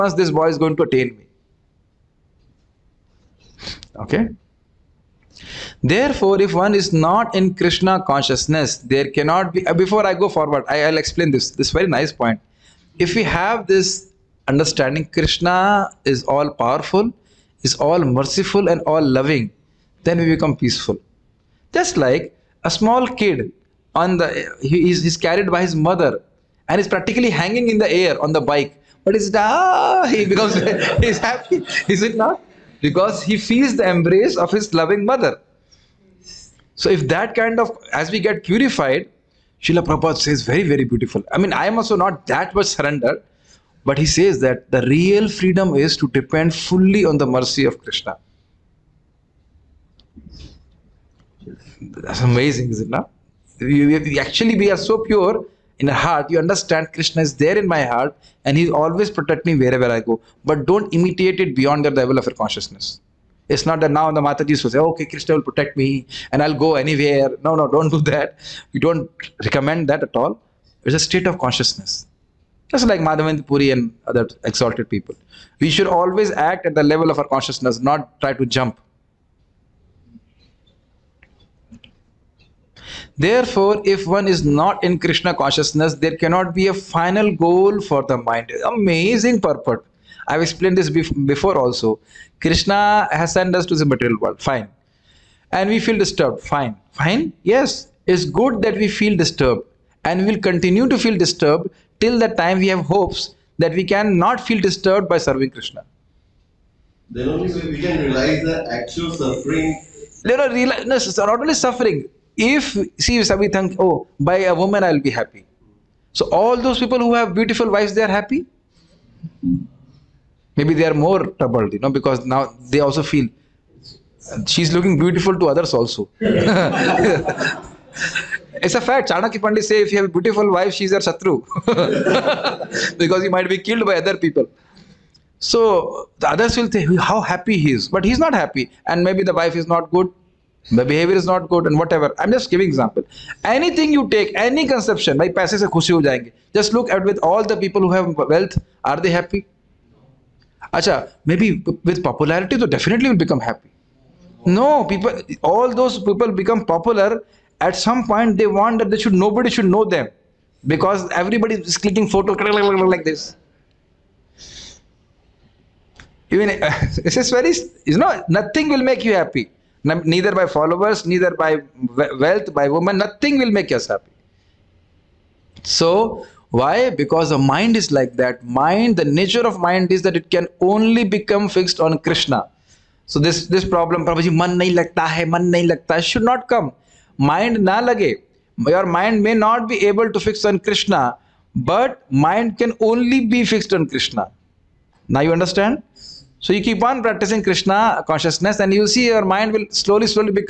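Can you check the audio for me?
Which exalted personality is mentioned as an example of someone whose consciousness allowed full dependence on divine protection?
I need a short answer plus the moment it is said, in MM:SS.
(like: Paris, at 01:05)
Madhavendra Puri, at 01:13.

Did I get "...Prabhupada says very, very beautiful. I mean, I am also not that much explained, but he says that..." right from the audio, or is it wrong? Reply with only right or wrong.
wrong.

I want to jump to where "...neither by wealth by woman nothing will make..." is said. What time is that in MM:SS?
02:51.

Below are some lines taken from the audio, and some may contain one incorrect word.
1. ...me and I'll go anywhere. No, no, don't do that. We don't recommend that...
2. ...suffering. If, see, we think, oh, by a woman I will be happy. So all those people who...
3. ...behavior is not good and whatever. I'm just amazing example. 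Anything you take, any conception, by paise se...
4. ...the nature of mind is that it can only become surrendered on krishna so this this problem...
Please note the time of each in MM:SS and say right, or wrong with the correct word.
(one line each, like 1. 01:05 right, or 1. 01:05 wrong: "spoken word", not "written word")
1. 01:05 right
2. 01:51 right
3. 02:20 wrong: "giving", not "amazing"
4. 02:58 wrong: "fixed", not "surrendered".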